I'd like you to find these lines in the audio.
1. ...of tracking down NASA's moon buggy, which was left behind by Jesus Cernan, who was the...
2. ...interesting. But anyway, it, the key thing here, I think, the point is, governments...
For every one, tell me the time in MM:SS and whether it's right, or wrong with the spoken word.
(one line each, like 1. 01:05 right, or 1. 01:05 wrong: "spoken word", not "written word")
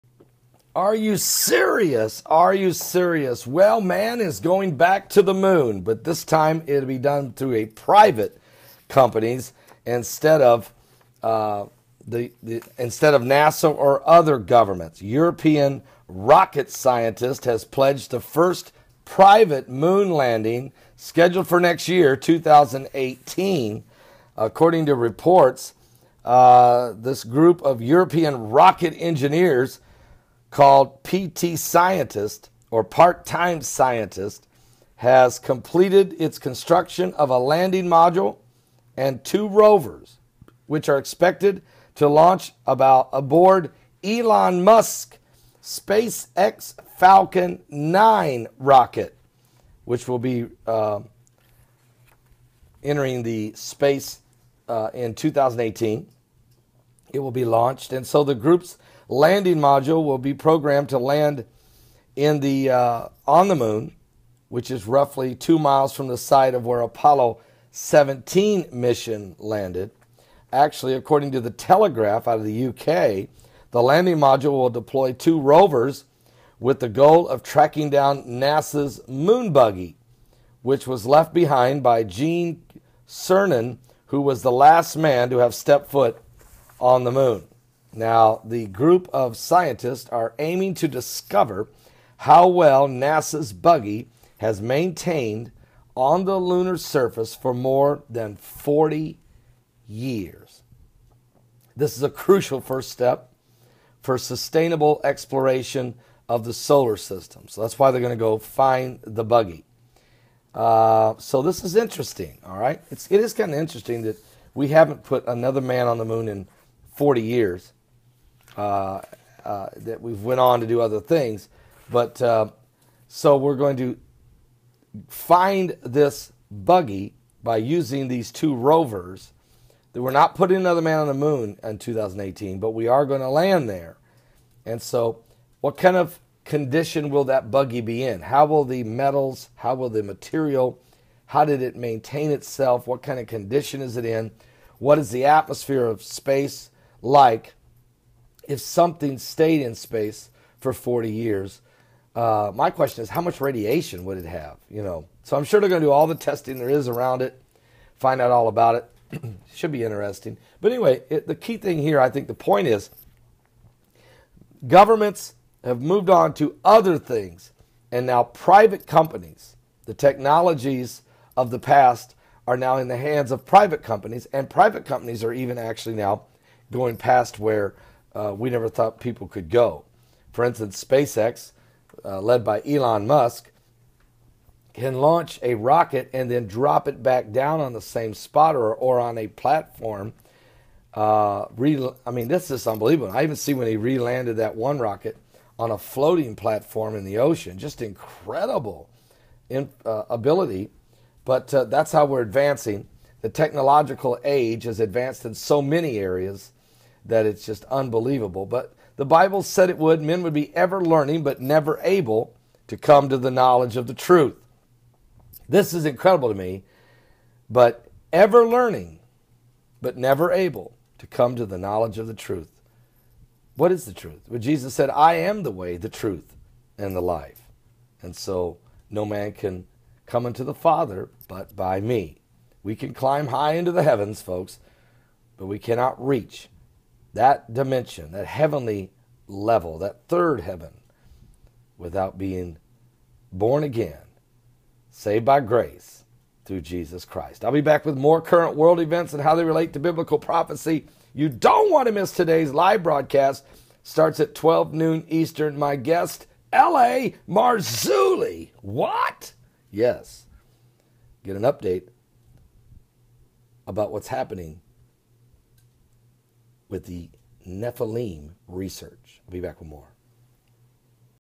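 1. 01:17 wrong: "Gene", not "Jesus"
2. 02:39 right.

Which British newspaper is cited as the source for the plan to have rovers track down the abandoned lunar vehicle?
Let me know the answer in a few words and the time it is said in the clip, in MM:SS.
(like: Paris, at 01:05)
The Telegraph, at 01:11.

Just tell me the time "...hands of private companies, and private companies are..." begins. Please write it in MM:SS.
02:52.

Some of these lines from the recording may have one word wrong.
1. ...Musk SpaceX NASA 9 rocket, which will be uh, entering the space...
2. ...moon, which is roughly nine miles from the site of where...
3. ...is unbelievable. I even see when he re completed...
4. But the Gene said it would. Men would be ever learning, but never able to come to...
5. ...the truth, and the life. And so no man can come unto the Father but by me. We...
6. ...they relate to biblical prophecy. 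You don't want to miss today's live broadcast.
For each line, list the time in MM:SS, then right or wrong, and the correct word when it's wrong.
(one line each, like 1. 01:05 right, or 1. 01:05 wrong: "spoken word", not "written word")
1. 00:44 wrong: "Falcon", not "NASA"
2. 01:03 wrong: "two", not "nine"
3. 03:12 wrong: "landed", not "completed"
4. 03:28 wrong: "Bible", not "Gene"
5. 03:45 right
6. 04:09 right.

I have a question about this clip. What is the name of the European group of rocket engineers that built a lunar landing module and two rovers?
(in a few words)
PT Scientist.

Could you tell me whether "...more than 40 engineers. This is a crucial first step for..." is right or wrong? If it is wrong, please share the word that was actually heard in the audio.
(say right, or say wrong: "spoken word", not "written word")
wrong: "years", not "engineers".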